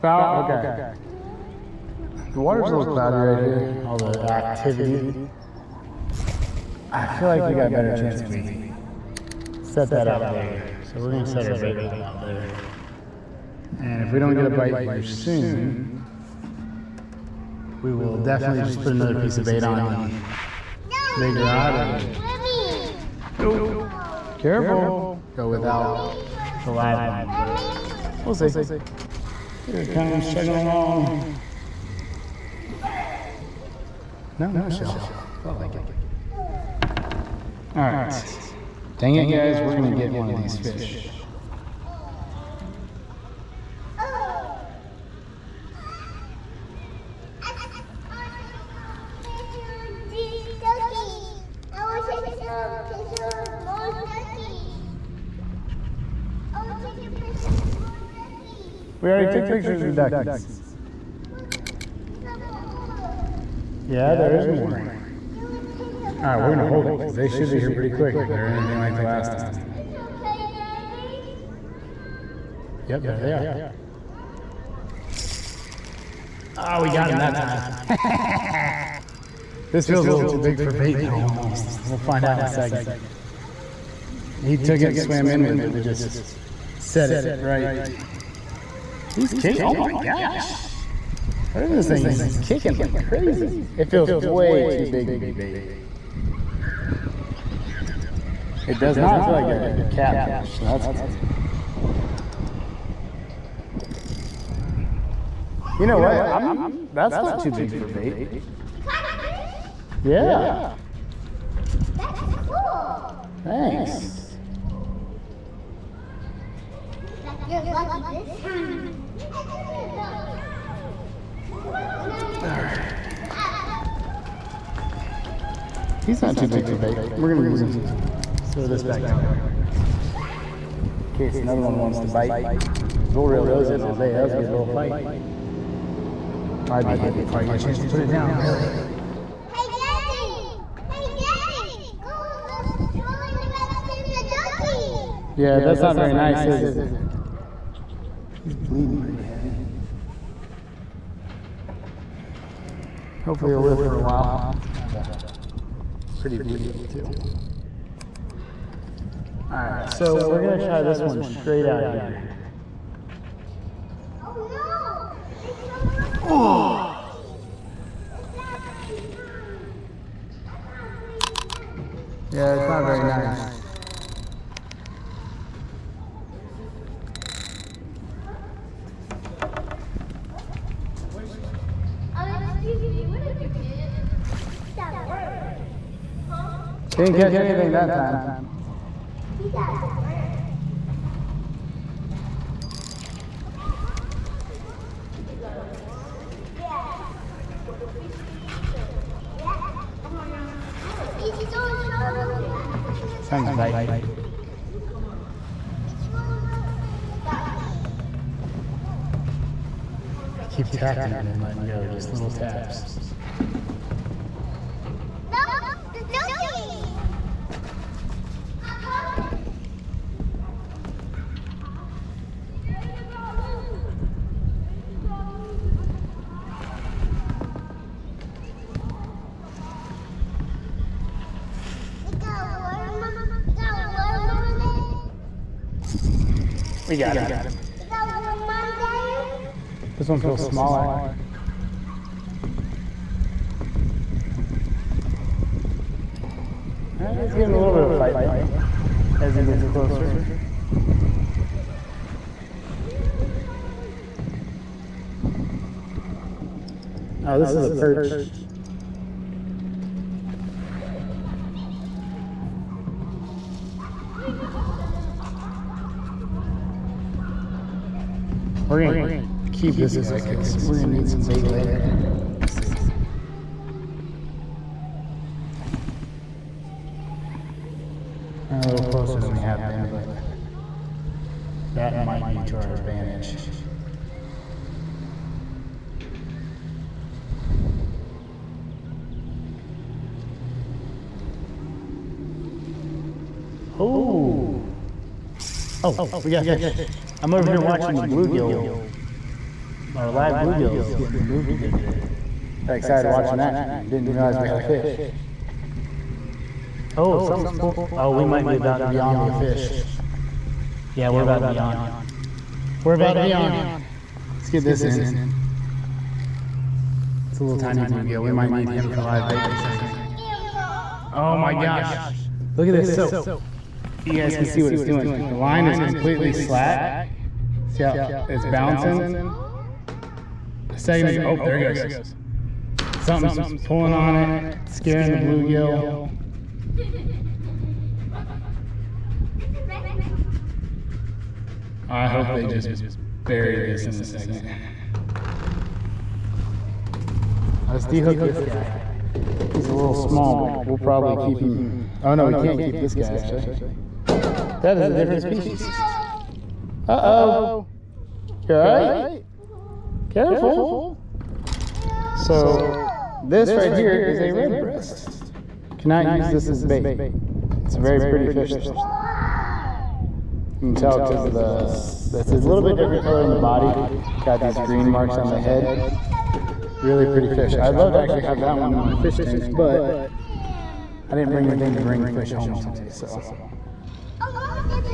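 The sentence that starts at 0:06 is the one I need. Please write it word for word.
I feel like we got a better chance if we set that out there.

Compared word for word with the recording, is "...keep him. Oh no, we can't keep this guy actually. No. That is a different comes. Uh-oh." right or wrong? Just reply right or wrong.
wrong.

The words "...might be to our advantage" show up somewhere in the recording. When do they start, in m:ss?
4:41.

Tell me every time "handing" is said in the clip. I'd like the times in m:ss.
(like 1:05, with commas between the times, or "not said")
not said.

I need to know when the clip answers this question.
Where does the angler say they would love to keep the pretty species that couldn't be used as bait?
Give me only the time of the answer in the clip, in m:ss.
6:18.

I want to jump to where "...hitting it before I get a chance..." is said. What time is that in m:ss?
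2:16.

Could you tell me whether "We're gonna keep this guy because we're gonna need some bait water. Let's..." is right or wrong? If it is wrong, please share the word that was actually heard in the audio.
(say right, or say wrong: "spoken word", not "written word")
wrong: "later", not "water".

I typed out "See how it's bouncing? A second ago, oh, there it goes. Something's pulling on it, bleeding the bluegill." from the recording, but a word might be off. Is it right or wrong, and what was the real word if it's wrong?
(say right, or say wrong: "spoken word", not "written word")
wrong: "scaring", not "bleeding".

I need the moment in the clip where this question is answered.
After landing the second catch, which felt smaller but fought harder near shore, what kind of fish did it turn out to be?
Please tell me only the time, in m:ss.
4:17.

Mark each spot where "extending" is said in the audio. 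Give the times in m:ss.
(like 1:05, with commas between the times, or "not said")
not said.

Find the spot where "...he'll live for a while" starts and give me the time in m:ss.
2:33.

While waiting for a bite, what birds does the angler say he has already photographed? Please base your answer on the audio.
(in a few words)
duckies.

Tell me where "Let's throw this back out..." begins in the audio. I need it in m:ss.
2:08.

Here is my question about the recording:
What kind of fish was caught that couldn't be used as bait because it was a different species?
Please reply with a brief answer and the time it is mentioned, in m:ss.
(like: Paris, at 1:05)
red breast, at 6:04.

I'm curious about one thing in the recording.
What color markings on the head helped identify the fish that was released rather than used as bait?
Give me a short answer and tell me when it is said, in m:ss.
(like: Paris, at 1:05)
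green, at 6:14.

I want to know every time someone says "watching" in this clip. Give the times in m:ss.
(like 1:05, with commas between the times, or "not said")
4:57, 5:03.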